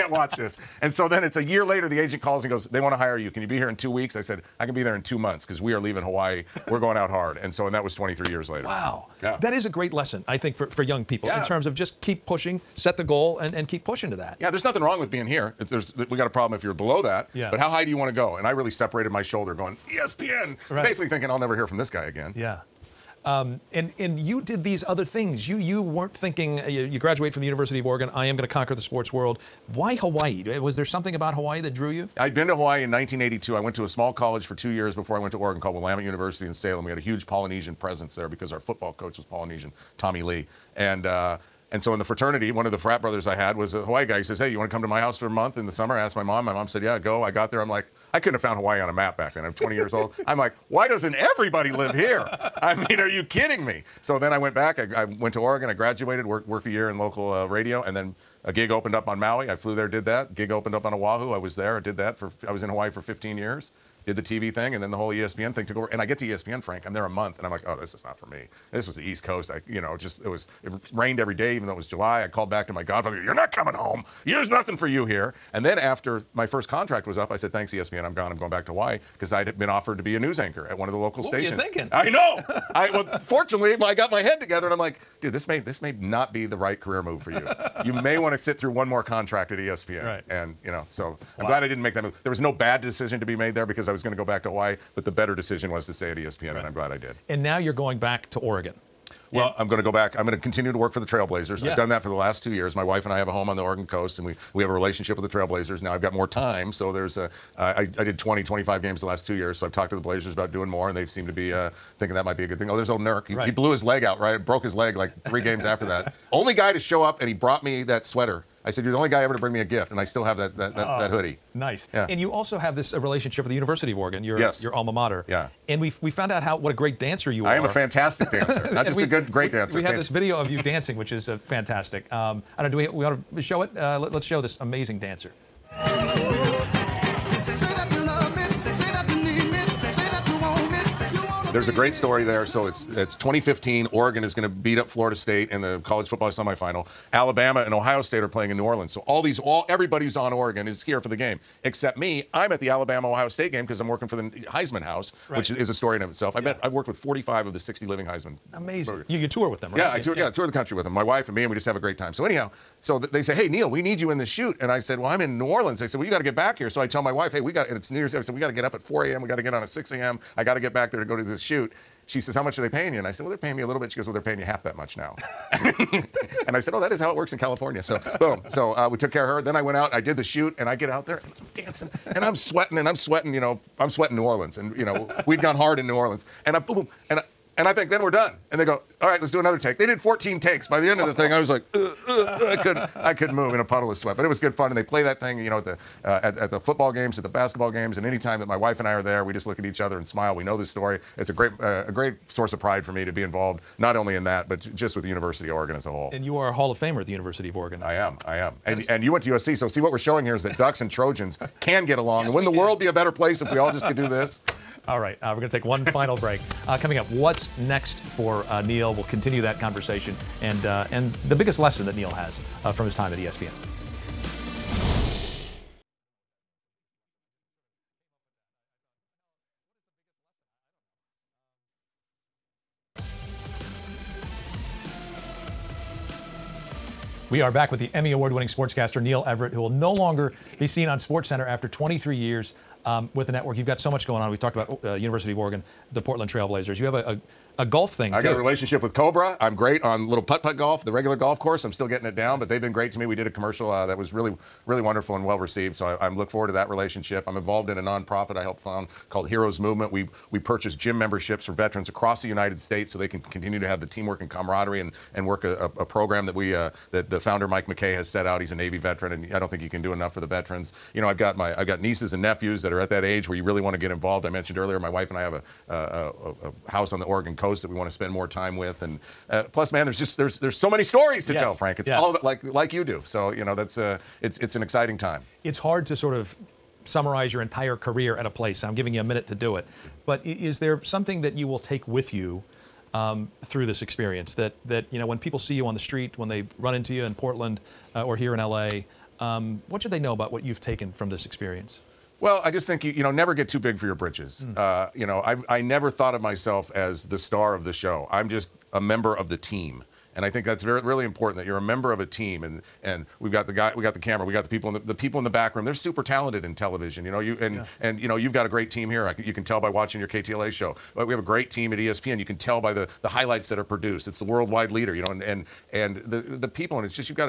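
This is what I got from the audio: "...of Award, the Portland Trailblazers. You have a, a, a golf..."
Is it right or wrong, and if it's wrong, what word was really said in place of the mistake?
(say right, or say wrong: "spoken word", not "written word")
wrong: "Oregon", not "Award".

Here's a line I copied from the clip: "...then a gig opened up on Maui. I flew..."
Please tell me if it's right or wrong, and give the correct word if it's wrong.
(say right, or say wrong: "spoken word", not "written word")
right.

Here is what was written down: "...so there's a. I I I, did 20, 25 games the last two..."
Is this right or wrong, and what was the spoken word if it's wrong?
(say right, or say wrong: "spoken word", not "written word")
right.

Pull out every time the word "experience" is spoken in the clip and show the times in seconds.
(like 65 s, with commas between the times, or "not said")
293 s, 301 s.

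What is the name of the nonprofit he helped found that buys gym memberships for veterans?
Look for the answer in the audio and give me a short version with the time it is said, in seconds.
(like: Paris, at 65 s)
Heroes Movement, at 259 s.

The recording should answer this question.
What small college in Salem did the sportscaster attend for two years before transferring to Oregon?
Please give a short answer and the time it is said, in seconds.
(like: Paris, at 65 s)
Willamette University, at 35 s.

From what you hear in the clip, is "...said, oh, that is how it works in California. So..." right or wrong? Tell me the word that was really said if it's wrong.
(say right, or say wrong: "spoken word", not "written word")
right.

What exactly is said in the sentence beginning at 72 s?
I called back to my godfather.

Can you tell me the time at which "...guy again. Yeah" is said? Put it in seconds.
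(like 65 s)
21 s.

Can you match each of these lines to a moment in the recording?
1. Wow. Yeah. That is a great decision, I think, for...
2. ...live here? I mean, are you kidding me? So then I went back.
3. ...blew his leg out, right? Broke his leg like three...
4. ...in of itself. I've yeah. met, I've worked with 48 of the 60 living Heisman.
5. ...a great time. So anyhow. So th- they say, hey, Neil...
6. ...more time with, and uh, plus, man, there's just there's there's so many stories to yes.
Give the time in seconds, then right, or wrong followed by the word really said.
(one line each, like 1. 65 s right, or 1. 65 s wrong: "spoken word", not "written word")
1. 8 s wrong: "lesson", not "decision"
2. 51 s right
3. 113 s right
4. 155 s wrong: "45", not "48"
5. 161 s right
6. 278 s right.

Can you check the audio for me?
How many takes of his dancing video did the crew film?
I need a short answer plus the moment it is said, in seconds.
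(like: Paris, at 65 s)
14, at 189 s.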